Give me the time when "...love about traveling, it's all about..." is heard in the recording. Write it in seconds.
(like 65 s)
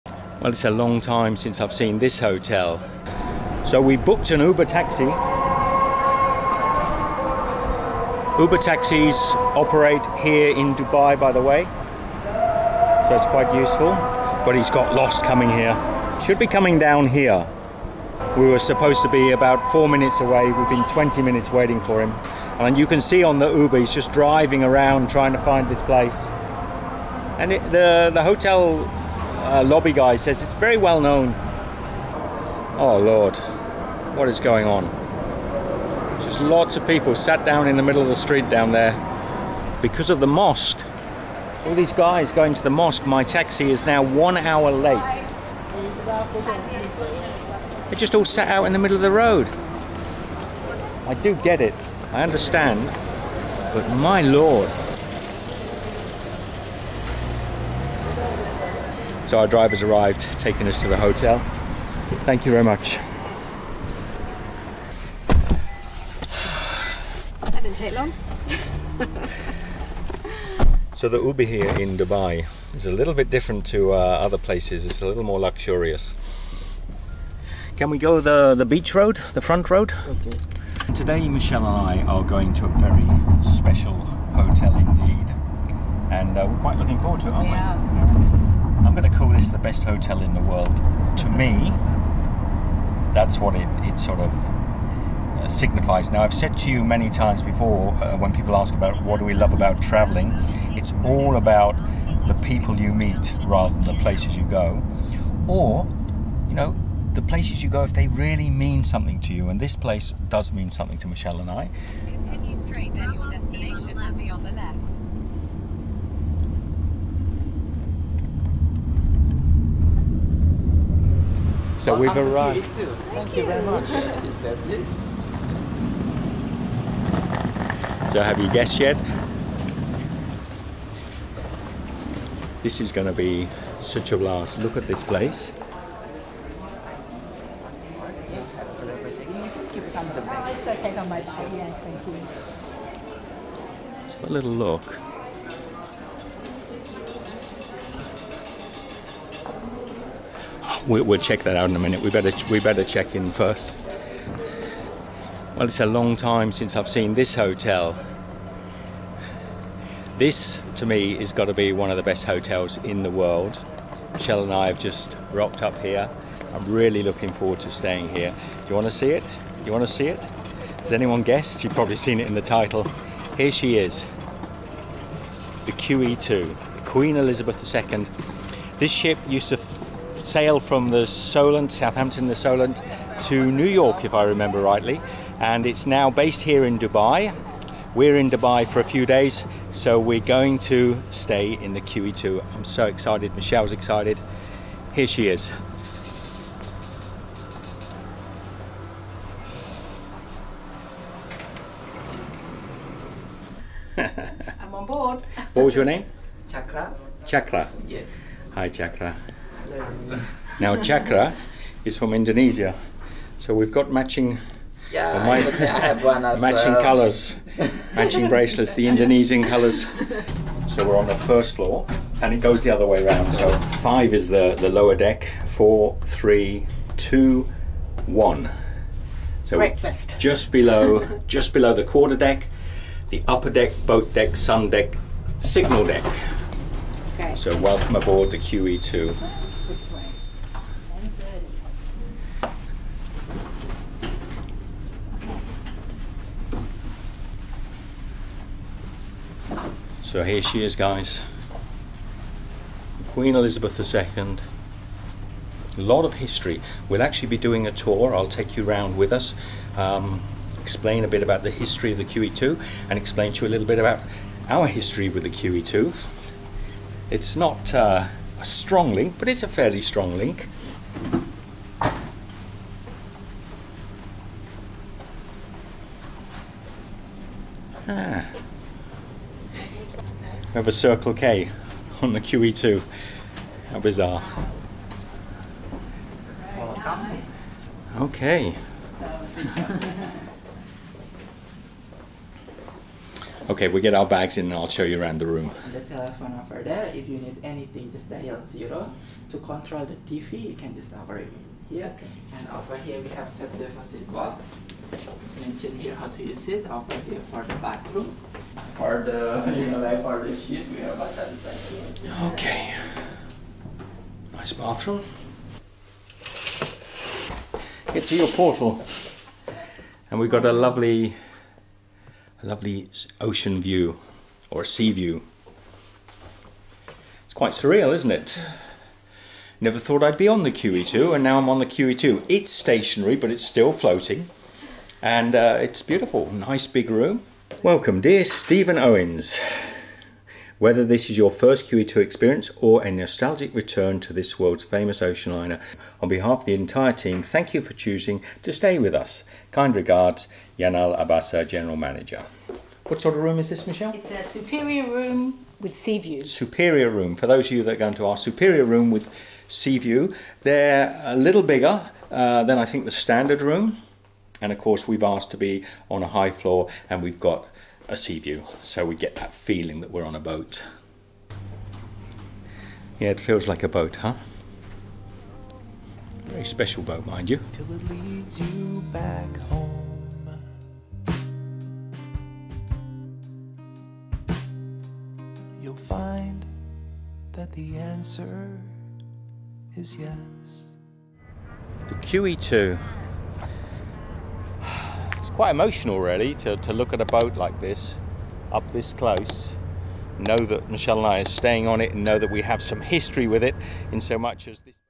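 99 s.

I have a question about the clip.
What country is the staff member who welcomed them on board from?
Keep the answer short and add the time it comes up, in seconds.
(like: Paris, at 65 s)
Indonesia, at 212 s.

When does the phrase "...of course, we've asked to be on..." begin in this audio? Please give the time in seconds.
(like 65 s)
364 s.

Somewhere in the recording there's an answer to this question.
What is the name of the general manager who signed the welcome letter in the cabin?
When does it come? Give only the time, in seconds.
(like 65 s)
350 s.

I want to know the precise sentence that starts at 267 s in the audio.
It's not uh, a strong link, but it's a fairly strong link.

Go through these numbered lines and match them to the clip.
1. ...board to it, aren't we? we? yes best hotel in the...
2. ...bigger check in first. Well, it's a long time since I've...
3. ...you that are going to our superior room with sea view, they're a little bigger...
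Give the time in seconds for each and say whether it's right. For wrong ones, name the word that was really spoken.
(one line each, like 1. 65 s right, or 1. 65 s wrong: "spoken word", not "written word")
1. 86 s wrong: "forward", not "board"
2. 152 s wrong: "better", not "bigger"
3. 357 s right.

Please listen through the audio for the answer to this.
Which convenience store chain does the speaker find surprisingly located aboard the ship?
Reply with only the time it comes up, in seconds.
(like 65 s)
280 s.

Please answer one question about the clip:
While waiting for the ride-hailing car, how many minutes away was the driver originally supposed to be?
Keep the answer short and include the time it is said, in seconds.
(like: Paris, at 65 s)
4, at 19 s.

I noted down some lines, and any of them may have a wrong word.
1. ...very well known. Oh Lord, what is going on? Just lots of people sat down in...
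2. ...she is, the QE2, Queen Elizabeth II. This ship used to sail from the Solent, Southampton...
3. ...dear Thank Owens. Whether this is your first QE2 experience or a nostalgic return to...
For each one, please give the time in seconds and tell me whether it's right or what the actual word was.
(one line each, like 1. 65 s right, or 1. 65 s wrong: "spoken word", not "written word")
1. 30 s right
2. 173 s right
3. 338 s wrong: "Stephen", not "Thank".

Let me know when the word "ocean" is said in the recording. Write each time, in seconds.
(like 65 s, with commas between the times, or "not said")
323 s, 345 s.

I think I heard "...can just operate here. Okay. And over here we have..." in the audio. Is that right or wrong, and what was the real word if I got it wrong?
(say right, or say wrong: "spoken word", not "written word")
right.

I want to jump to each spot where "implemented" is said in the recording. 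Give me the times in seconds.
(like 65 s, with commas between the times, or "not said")
not said.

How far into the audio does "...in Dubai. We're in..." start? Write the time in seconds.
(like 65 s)
186 s.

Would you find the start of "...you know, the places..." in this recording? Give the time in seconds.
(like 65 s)
106 s.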